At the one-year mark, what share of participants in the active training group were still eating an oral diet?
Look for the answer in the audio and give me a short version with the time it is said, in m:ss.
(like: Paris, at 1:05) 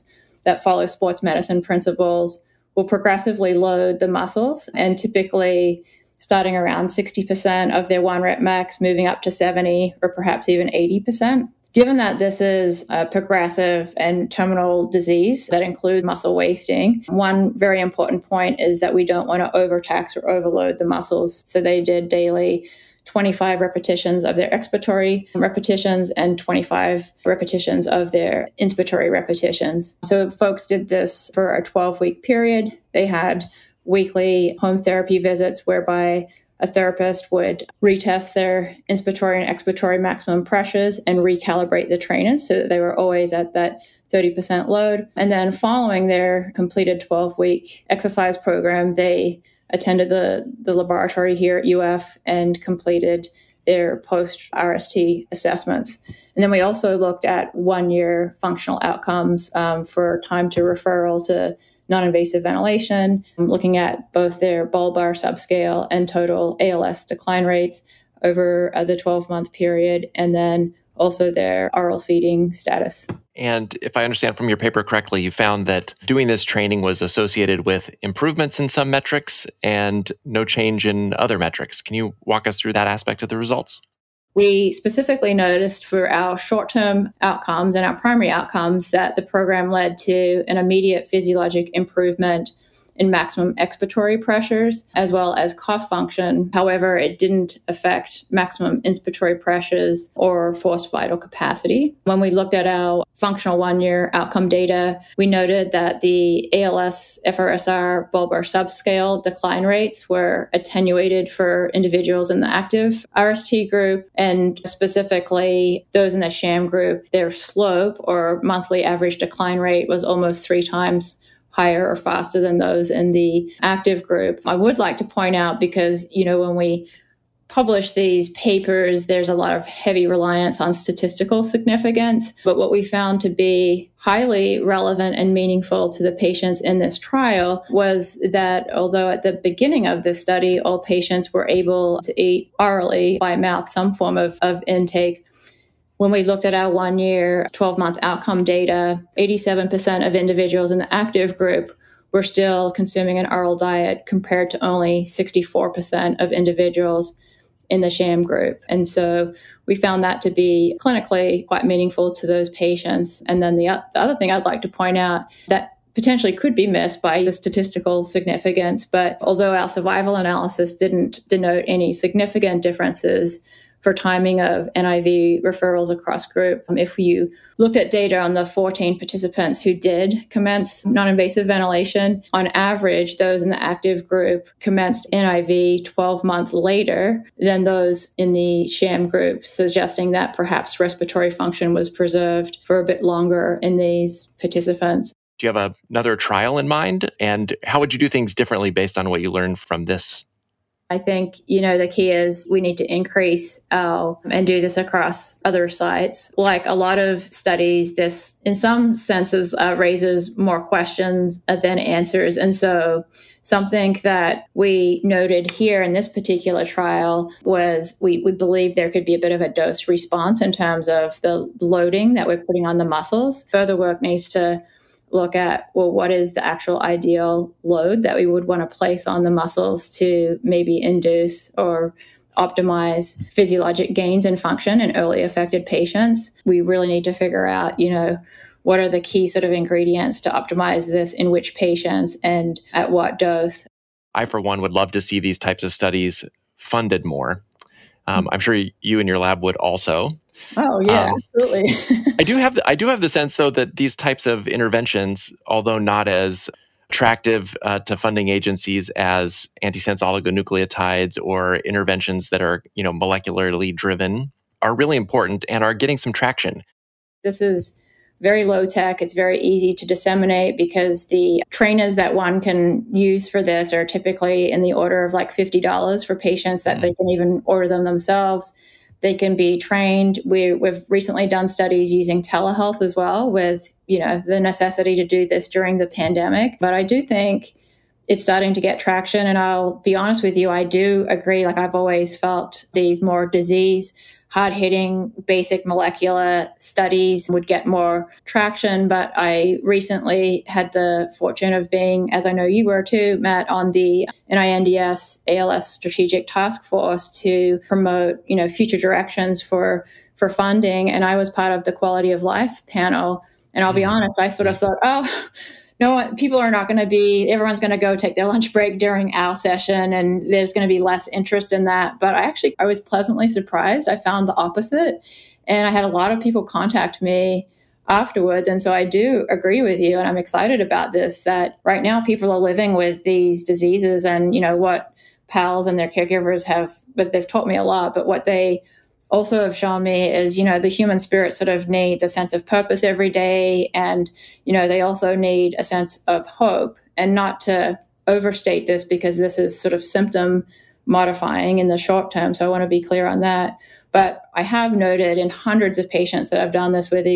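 87%, at 2:29.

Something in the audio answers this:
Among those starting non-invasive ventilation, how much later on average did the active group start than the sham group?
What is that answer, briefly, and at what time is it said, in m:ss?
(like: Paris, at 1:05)
12 months, at 3:05.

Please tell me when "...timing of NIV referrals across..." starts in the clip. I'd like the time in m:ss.
2:53.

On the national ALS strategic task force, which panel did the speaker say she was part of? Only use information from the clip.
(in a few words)
quality of life.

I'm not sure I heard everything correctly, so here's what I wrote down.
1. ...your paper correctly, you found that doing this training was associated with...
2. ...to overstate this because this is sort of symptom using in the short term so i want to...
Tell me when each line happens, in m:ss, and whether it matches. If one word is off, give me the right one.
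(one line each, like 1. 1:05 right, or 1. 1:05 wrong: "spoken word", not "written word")
1. 1:14 right
2. 5:47 wrong: "modifying", not "using".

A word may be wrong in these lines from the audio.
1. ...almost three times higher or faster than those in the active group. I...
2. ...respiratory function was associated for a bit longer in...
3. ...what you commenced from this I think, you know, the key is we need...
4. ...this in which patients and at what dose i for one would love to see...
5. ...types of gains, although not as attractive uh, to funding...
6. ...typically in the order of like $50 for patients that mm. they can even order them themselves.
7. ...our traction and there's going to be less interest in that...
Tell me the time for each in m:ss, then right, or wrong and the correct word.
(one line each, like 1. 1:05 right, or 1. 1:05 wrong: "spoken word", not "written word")
1. 2:00 right
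2. 3:10 wrong: "preserved", not "associated"
3. 3:19 wrong: "learned", not "commenced"
4. 4:00 right
5. 4:13 wrong: "interventions", not "gains"
6. 4:33 right
7. 5:19 wrong: "session", not "traction".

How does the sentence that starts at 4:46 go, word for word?
But I do think it's starting to get traction, and I'll be honest with you, I do agree.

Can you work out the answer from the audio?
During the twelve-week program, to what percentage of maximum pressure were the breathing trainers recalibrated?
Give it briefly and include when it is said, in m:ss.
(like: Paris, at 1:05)
30%, at 0:44.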